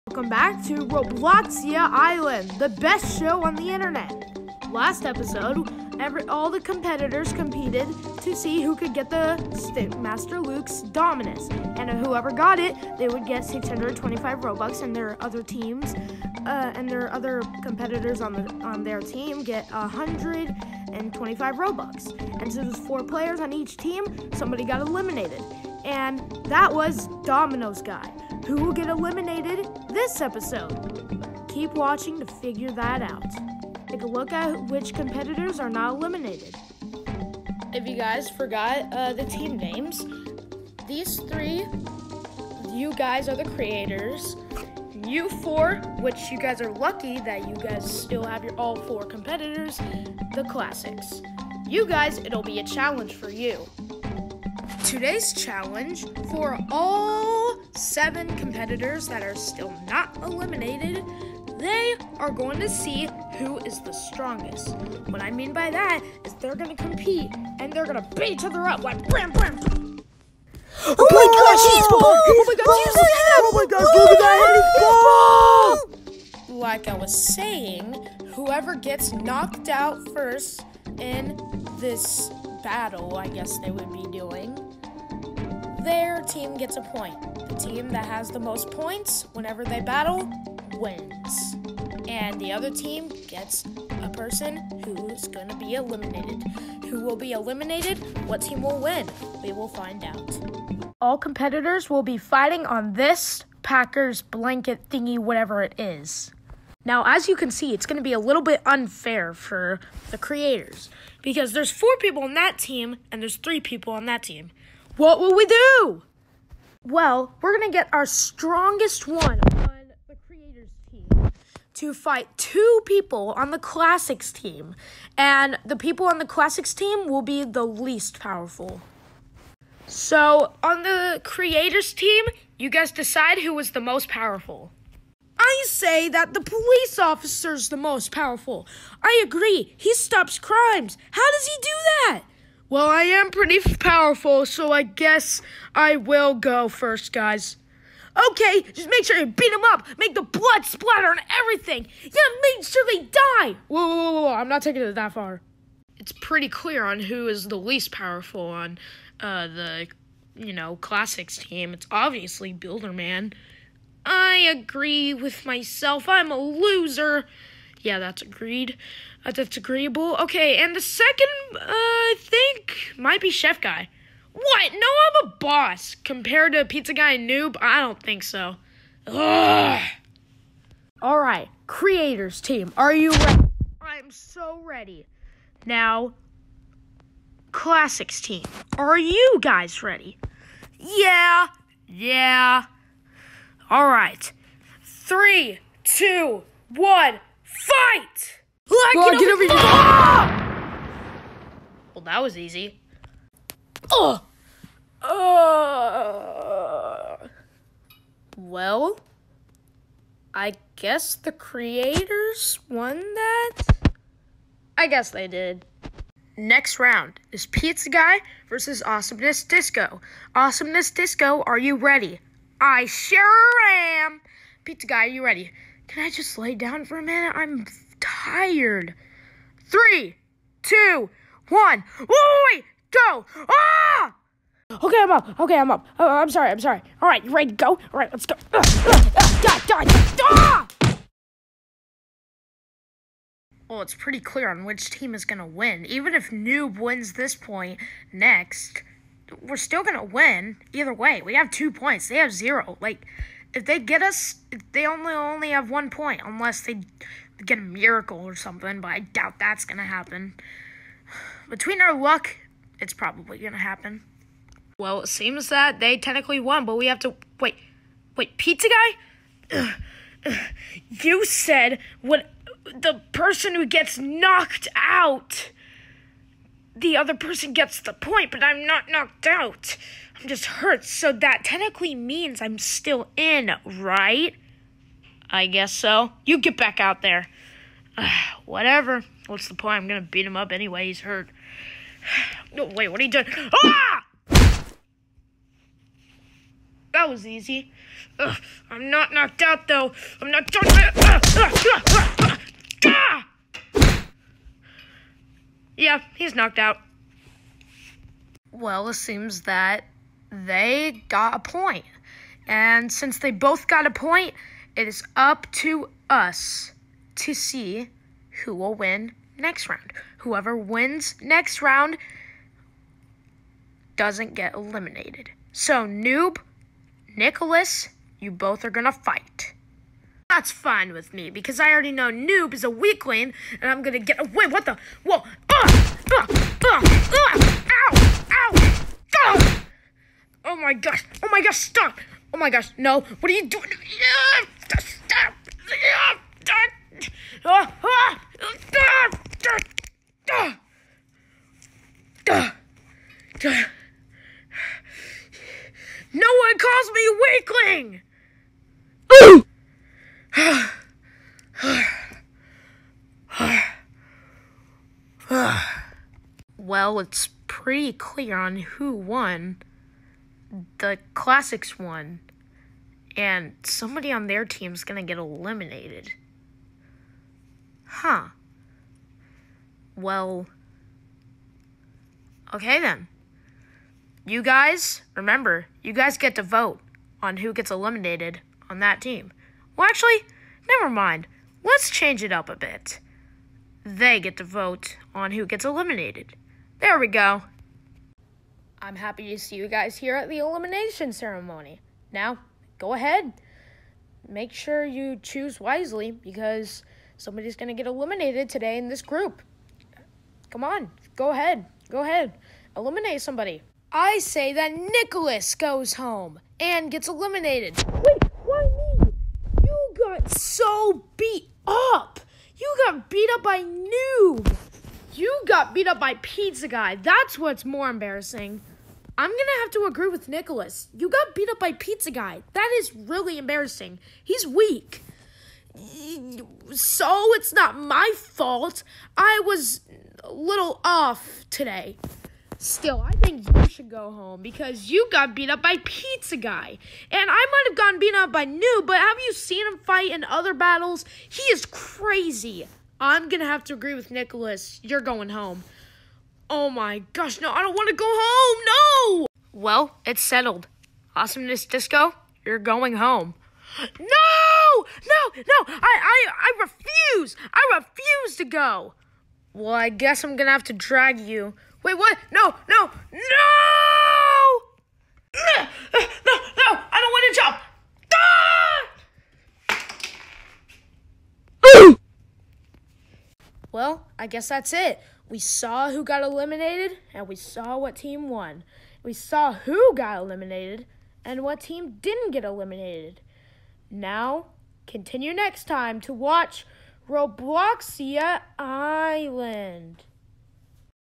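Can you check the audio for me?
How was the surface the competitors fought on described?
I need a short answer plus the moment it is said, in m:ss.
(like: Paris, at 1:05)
Packers blanket, at 1:43.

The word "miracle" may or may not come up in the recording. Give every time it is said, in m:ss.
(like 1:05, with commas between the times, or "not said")
4:17.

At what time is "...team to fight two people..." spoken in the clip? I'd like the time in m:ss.
2:00.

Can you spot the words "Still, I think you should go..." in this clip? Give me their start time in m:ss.
7:22.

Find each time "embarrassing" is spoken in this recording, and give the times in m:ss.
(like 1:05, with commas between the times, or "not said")
7:07, 7:13.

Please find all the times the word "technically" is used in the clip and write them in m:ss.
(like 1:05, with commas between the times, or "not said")
4:25, 4:41.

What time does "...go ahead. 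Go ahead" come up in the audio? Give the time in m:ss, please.
6:51.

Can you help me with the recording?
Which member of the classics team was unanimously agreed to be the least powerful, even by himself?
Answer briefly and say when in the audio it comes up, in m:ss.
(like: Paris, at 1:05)
Builderman, at 2:42.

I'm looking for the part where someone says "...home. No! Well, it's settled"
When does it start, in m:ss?
7:38.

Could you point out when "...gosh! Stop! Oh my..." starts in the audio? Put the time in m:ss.
5:41.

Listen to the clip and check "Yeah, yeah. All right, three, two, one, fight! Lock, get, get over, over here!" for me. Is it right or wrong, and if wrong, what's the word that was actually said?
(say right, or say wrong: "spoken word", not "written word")
right.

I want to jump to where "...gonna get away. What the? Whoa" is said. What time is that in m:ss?
5:33.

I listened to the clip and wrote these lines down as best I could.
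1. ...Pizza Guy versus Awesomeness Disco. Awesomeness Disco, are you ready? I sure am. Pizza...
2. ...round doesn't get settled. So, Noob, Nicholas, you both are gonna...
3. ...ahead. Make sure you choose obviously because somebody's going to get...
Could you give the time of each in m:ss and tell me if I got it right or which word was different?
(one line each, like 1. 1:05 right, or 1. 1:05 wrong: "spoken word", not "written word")
1. 3:37 right
2. 5:21 wrong: "eliminated", not "settled"
3. 6:42 wrong: "wisely", not "obviously".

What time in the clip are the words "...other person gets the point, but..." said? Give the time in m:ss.
4:36.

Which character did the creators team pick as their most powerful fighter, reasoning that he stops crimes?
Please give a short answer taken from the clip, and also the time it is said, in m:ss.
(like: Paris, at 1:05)
The police officer, at 2:16.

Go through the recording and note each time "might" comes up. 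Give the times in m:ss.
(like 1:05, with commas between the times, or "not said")
2:53, 7:27.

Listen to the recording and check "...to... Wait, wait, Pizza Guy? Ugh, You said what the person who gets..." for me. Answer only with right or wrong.
right.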